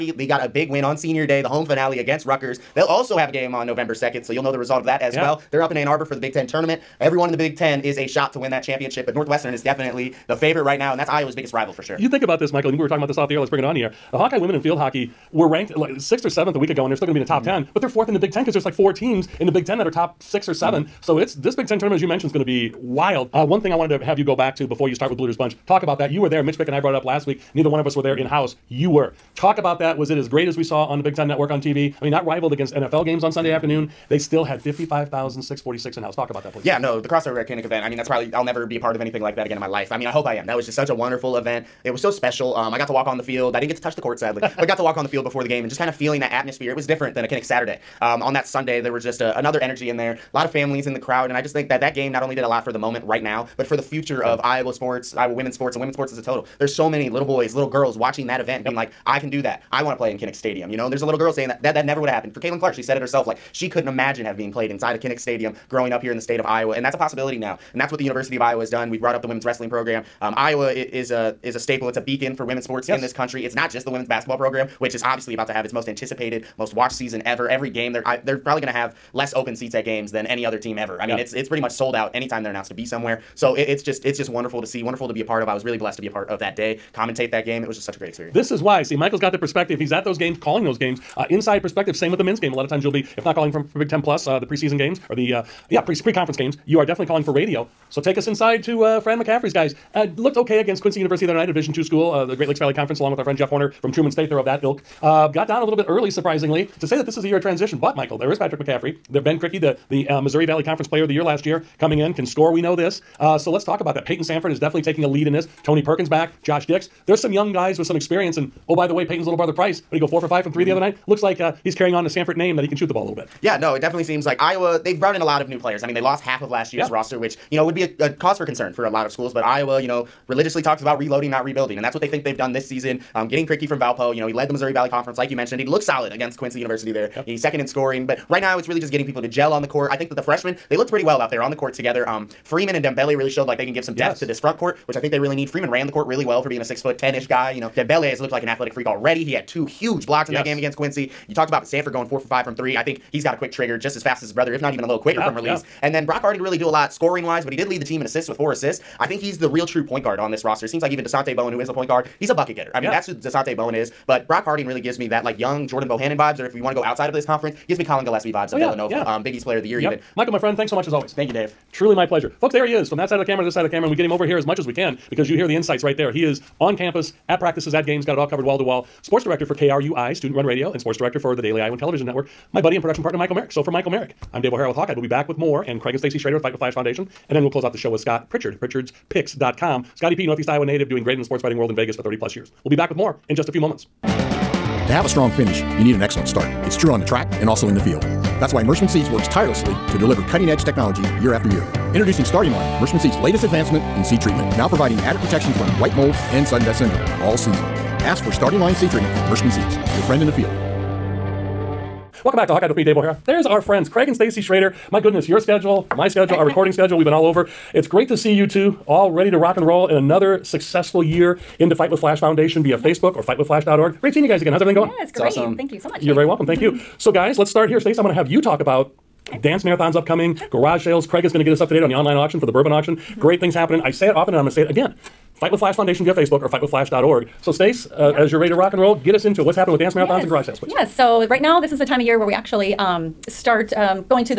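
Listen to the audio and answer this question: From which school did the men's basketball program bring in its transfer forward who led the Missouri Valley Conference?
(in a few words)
Valpo.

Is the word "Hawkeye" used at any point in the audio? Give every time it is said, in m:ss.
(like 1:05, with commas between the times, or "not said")
0:14, 3:04, 3:32.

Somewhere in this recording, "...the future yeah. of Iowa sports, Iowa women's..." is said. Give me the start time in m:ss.
0:53.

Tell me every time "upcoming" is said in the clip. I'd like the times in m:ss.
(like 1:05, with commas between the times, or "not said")
3:49.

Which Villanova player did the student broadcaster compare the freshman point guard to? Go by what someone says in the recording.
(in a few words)
Collin Gillespie.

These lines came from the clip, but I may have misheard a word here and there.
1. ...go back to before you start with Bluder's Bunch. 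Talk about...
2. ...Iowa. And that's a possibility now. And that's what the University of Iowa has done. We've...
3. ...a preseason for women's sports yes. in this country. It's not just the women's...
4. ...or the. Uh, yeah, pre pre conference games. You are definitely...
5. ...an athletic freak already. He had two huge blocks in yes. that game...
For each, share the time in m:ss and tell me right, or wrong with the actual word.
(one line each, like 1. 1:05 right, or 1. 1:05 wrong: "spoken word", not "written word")
1. 0:24 right
2. 1:06 right
3. 1:11 wrong: "beacon", not "preseason"
4. 1:35 right
5. 2:28 right.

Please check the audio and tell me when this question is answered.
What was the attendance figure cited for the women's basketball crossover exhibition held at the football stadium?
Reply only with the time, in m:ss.
0:34.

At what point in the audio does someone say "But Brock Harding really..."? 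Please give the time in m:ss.
2:44.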